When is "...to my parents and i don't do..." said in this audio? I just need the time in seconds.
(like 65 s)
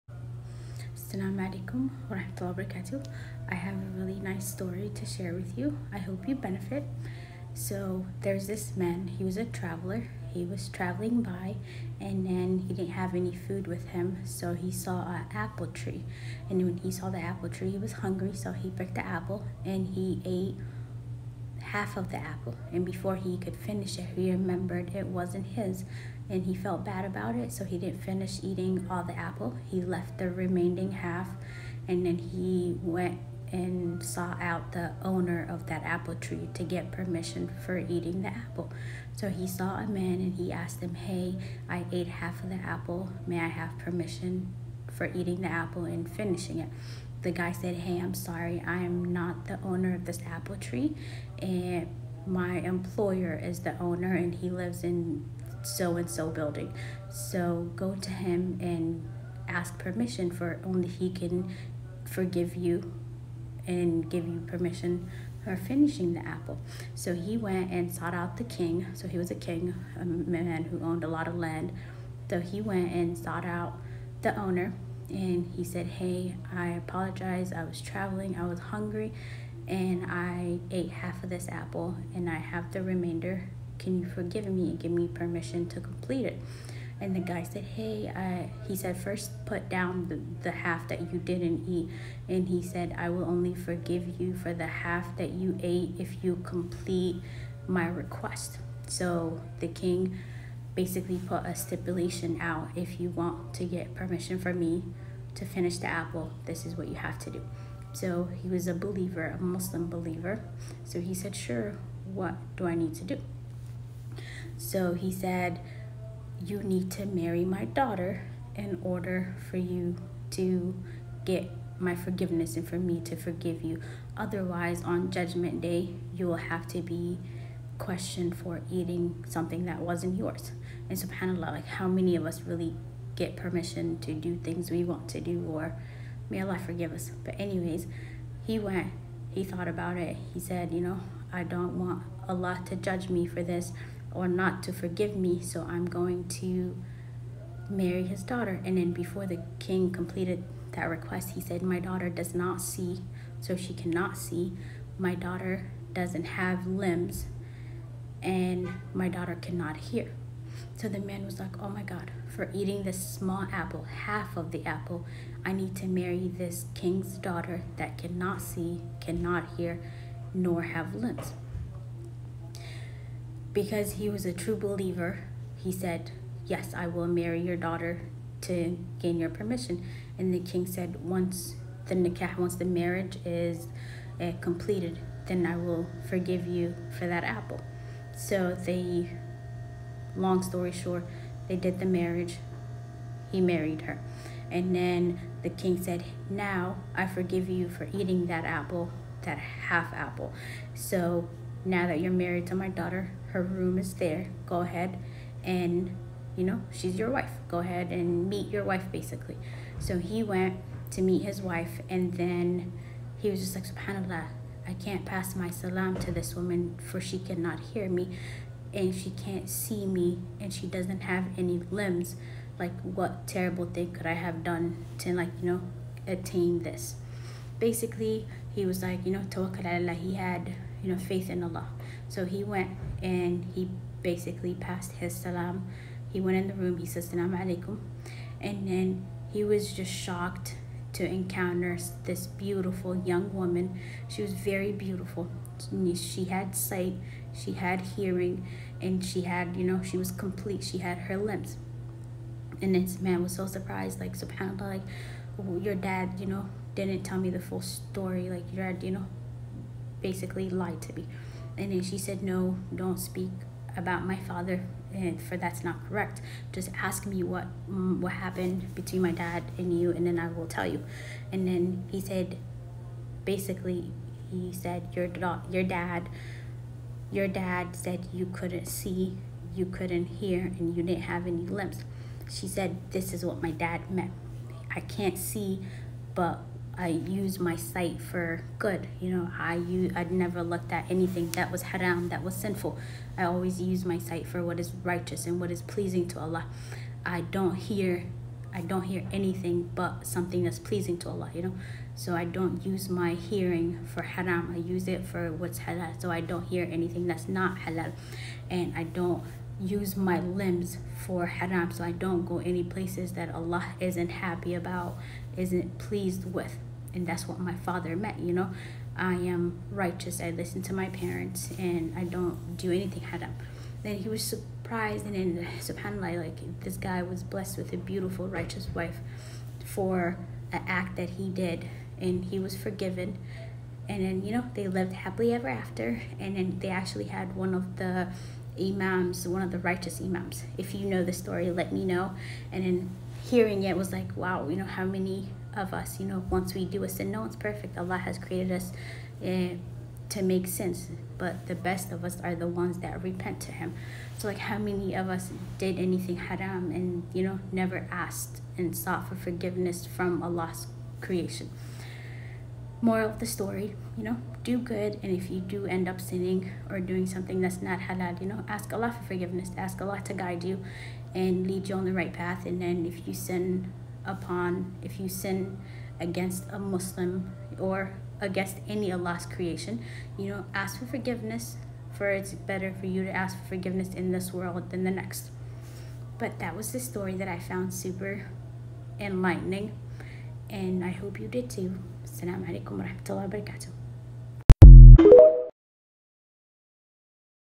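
320 s.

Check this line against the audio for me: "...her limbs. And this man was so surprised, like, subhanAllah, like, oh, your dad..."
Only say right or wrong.
right.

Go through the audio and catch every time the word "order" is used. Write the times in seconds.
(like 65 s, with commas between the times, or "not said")
118 s.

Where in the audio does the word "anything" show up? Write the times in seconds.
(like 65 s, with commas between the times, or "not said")
290 s, 299 s, 306 s, 322 s, 355 s.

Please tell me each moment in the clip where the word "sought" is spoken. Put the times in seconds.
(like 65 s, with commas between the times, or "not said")
34 s, 67 s, 73 s, 358 s.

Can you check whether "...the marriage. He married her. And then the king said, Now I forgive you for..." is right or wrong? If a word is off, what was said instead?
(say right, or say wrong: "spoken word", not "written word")
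right.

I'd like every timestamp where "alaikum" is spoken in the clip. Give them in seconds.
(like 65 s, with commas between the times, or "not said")
1 s, 237 s, 392 s.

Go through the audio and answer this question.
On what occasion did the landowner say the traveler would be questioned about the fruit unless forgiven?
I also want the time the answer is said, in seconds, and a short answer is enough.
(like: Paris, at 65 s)
Judgment Day, at 125 s.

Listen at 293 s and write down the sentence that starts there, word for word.
I always use my sight for what is righteous and what is pleasing to Allah.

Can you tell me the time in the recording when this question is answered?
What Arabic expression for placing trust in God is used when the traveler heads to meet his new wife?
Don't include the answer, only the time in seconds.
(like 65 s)
229 s.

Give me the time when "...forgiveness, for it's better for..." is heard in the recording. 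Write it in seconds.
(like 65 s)
380 s.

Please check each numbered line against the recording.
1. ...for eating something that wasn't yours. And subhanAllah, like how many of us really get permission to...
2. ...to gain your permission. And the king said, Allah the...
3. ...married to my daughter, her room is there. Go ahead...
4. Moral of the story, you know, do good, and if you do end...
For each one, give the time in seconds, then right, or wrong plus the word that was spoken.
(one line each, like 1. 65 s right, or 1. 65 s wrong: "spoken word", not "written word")
1. 128 s right
2. 178 s wrong: "Once", not "Allah"
3. 202 s right
4. 362 s right.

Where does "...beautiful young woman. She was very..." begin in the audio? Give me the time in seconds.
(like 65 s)
242 s.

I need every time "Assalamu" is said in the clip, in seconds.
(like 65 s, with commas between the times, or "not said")
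1 s, 392 s.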